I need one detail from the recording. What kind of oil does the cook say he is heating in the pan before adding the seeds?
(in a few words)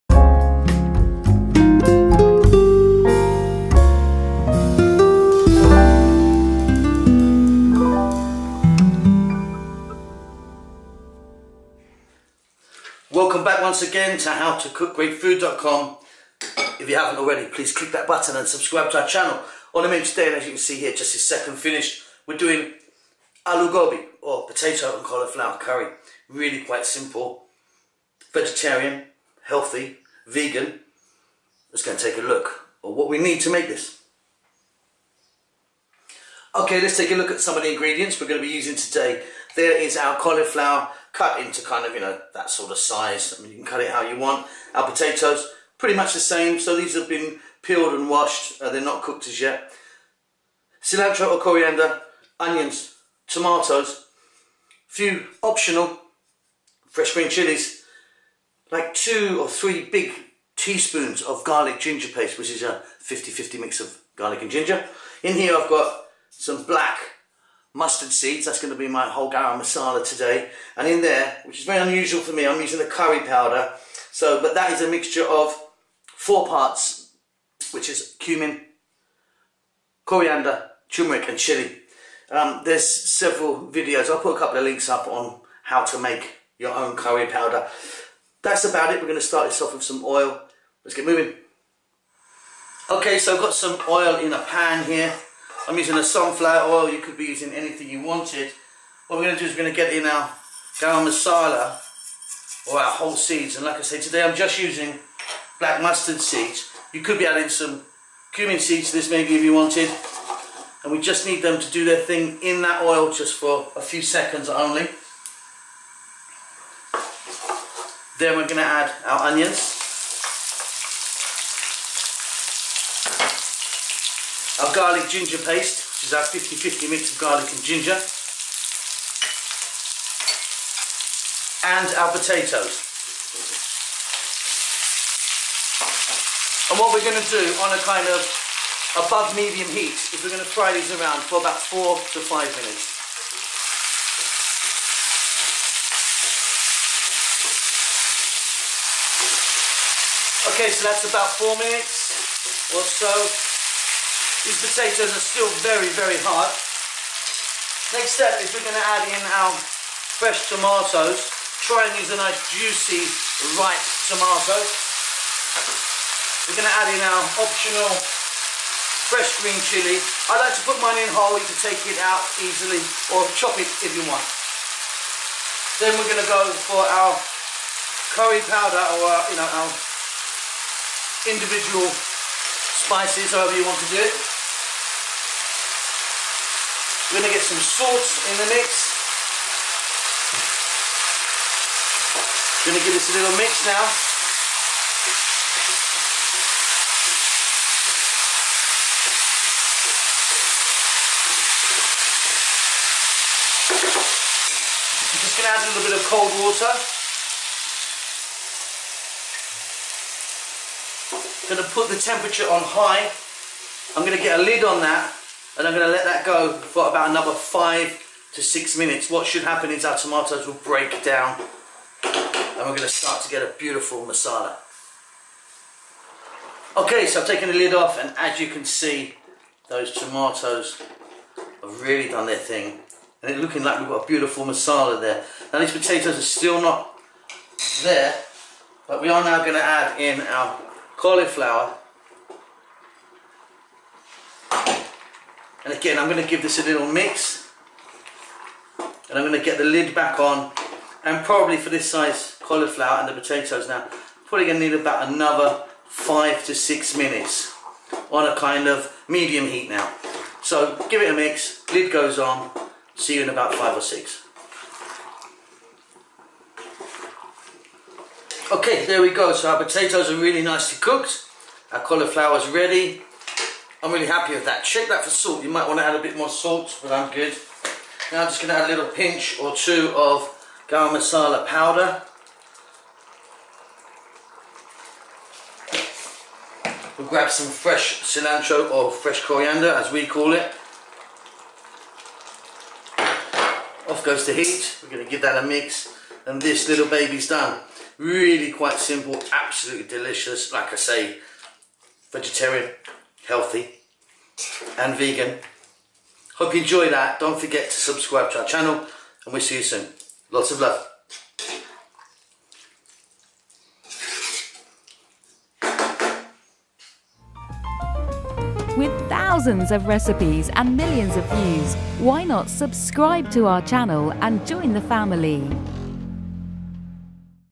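sunflower oil.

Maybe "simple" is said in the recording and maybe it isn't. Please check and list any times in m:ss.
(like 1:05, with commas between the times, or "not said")
0:26, 4:58.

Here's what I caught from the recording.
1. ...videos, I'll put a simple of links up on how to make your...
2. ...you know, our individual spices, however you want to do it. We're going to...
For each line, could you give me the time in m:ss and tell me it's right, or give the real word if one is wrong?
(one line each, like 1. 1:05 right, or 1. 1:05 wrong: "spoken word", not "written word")
1. 1:23 wrong: "couple", not "simple"
2. 2:59 right.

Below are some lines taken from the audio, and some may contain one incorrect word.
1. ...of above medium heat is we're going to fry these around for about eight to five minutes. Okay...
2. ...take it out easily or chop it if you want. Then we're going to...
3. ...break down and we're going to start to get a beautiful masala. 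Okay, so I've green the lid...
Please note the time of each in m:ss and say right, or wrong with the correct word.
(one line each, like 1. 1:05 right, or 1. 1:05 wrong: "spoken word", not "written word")
1. 2:18 wrong: "four", not "eight"
2. 2:51 right
3. 3:40 wrong: "taken", not "green".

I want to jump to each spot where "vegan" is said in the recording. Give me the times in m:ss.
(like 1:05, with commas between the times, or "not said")
0:30, 5:04.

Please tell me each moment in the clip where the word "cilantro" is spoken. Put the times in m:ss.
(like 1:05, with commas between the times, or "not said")
0:50, 4:48.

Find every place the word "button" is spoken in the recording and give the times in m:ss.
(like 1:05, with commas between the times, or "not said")
0:18.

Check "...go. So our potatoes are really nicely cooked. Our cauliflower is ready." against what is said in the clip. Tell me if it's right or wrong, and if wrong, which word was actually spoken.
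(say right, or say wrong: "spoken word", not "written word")
right.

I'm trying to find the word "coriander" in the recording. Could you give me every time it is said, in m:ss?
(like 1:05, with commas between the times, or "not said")
0:51, 1:20, 4:49.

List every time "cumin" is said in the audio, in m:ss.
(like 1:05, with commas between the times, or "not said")
1:18, 1:48.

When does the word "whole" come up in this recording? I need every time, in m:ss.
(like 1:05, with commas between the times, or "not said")
1:09, 1:42, 2:51.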